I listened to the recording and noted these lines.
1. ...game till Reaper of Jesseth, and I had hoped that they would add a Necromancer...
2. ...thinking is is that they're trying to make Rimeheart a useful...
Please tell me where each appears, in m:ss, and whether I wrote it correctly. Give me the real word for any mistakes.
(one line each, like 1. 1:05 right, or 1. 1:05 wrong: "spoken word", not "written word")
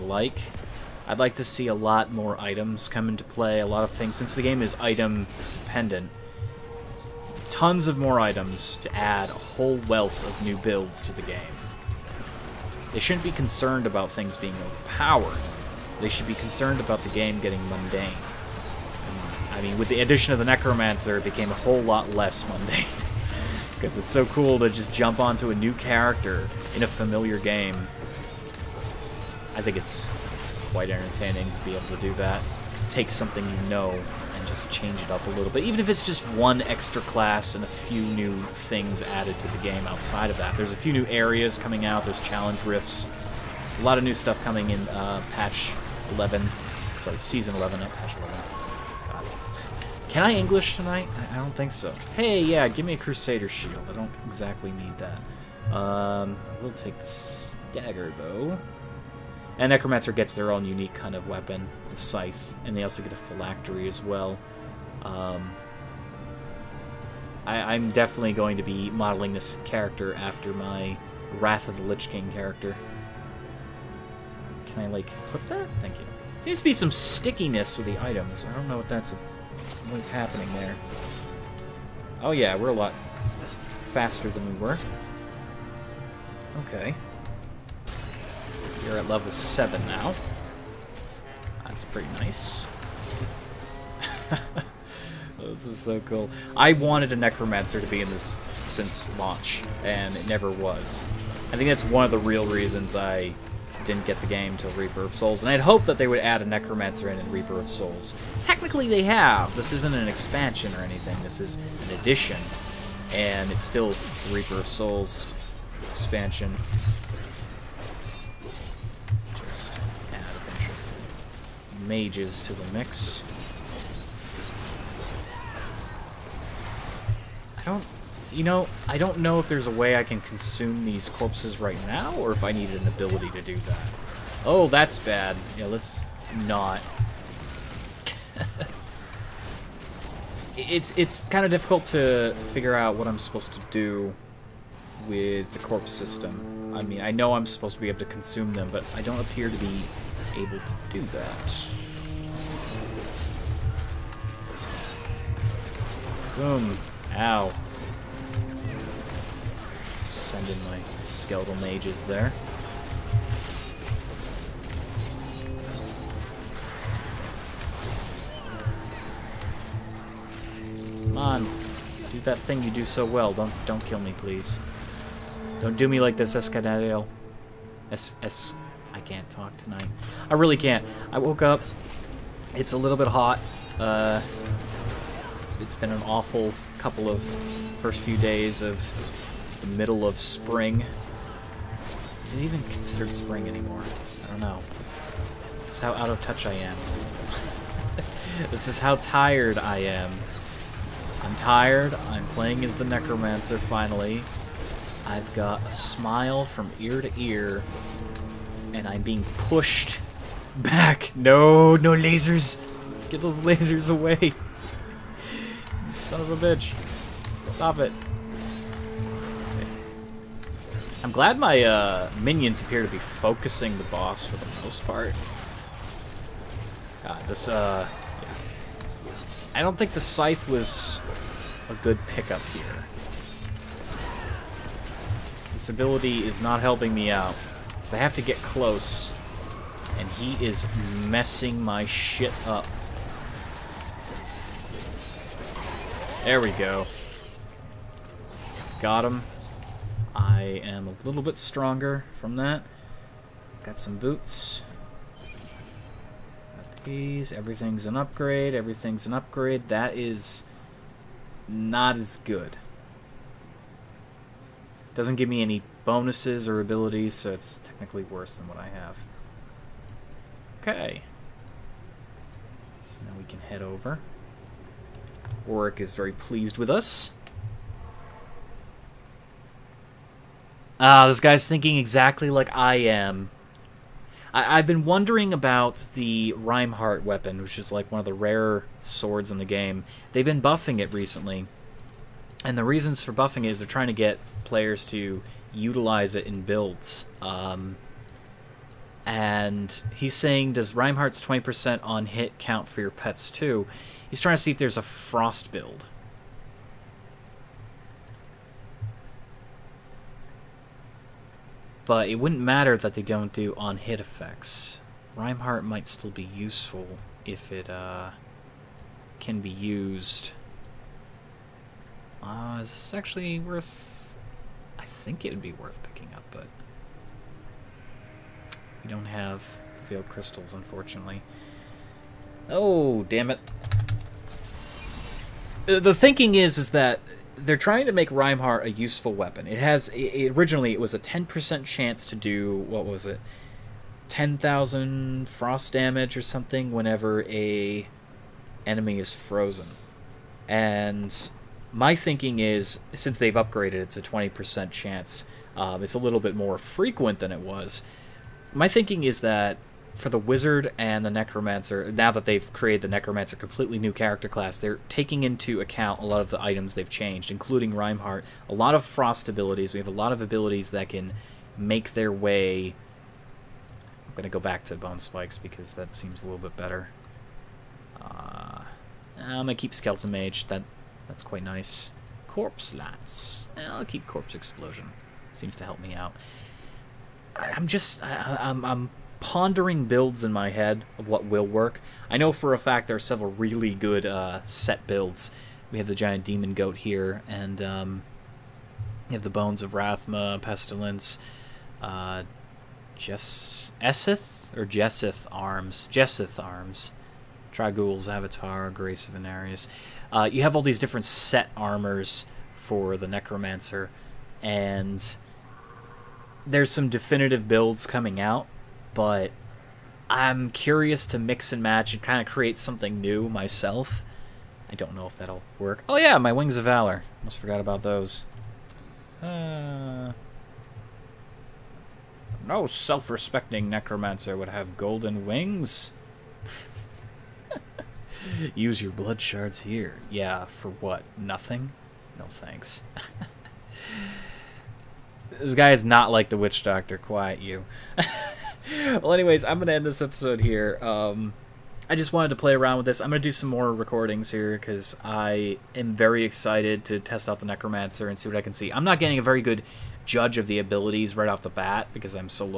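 1. 1:44 wrong: "Souls", not "Jesseth"
2. 5:35 right.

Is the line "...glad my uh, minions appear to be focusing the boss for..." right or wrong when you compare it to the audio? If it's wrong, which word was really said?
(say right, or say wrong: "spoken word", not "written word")
right.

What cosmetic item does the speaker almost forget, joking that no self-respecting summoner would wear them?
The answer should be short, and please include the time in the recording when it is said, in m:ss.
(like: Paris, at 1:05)
Wings of Valor, at 7:06.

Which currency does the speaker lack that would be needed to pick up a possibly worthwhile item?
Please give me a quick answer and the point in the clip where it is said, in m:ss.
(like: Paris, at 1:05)
Veiled crystals, at 5:29.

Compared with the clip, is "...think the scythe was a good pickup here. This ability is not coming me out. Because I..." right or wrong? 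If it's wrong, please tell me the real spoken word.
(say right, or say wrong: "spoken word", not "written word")
wrong: "helping", not "coming".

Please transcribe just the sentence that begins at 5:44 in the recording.
10,000 frost damage or something whenever a enemy is frozen.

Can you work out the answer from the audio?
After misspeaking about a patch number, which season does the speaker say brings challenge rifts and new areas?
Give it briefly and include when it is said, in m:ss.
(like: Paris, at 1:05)
Season 11, at 0:47.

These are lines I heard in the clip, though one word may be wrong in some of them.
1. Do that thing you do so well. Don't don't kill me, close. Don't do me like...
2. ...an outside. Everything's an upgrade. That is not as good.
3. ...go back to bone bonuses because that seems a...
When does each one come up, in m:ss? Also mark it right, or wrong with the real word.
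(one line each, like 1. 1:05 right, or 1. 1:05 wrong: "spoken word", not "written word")
1. 2:52 wrong: "please", not "close"
2. 4:17 wrong: "upgrade", not "outside"
3. 6:14 wrong: "spikes", not "bonuses".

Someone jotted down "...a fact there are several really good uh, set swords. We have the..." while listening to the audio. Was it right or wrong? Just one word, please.
wrong.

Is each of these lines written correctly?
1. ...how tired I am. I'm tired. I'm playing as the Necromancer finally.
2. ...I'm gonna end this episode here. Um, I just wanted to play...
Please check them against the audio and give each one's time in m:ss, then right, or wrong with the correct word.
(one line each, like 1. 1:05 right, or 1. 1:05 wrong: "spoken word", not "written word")
1. 3:18 right
2. 7:29 right.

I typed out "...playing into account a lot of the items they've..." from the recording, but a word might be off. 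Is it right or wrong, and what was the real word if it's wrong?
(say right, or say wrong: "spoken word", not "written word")
wrong: "taking", not "playing".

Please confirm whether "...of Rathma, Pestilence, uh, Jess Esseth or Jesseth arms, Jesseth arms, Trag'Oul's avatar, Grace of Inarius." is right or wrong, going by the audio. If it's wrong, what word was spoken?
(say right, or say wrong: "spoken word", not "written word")
right.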